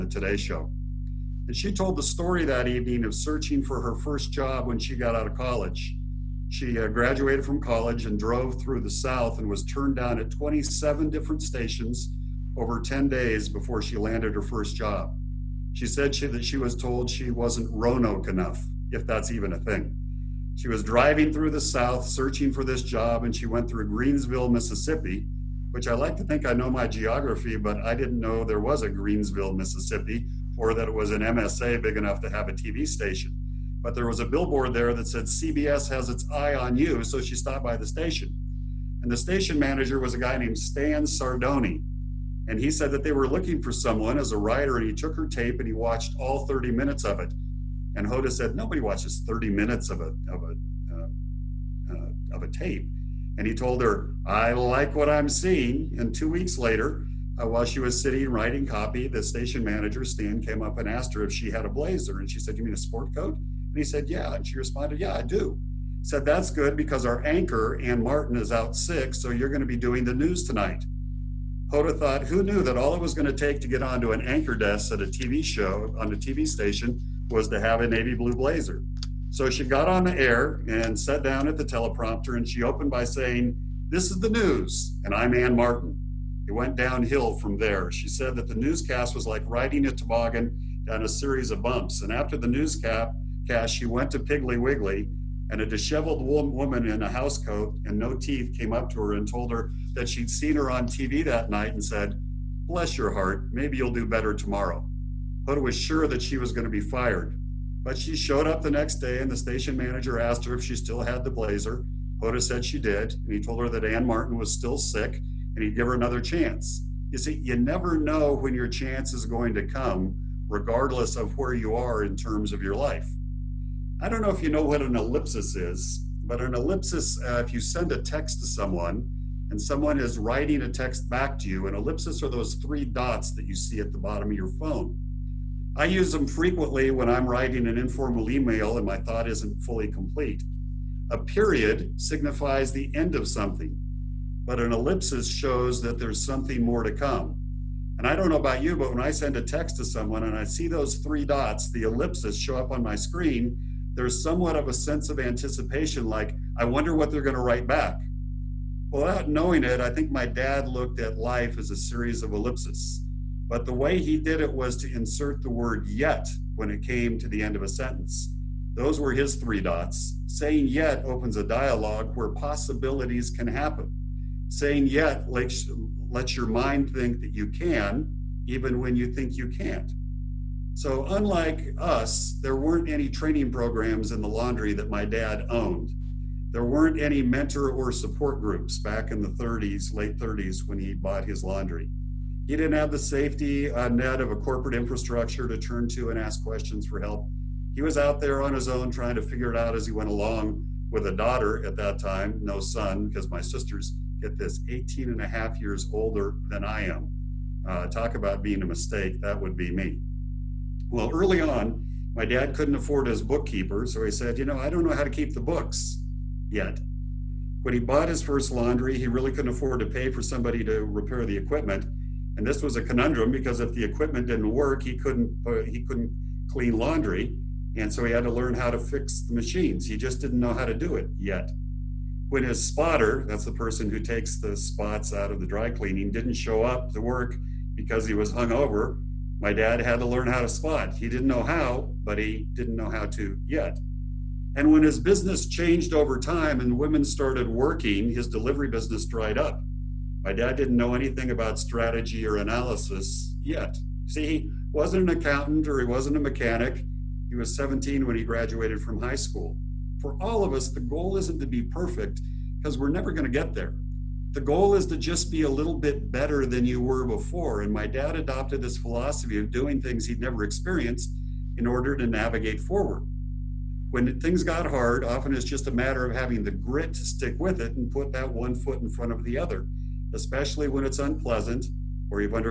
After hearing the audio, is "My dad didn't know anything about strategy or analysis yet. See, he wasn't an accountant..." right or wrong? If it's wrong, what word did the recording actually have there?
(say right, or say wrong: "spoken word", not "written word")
right.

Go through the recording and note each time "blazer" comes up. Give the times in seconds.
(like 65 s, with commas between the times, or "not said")
61 s, 78 s, 111 s.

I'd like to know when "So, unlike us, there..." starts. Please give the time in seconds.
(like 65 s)
180 s.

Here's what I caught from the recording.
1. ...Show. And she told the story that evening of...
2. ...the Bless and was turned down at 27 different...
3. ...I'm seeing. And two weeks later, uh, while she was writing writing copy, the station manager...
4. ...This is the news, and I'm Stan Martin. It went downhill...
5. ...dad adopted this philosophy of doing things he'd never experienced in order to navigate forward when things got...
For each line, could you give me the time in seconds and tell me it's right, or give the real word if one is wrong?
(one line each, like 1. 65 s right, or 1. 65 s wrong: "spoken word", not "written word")
1. 0 s right
2. 8 s wrong: "South", not "Bless"
3. 55 s wrong: "sitting", not "writing"
4. 83 s wrong: "Ann", not "Stan"
5. 267 s right.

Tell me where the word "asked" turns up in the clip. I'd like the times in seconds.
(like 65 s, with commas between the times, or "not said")
60 s, 110 s.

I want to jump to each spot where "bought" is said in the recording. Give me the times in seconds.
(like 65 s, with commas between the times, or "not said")
190 s, 217 s.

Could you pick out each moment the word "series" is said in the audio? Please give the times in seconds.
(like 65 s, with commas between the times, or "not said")
91 s, 161 s.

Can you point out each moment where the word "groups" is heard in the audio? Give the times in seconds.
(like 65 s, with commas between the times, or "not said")
188 s.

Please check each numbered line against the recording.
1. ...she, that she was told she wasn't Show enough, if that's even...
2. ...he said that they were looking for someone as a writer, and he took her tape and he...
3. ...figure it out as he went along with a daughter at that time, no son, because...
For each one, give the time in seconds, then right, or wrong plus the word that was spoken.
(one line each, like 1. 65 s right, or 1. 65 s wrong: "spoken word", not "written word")
1. 16 s wrong: "Roanoke", not "Show"
2. 42 s right
3. 199 s right.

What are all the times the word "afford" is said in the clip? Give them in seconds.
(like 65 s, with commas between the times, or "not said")
212 s, 219 s.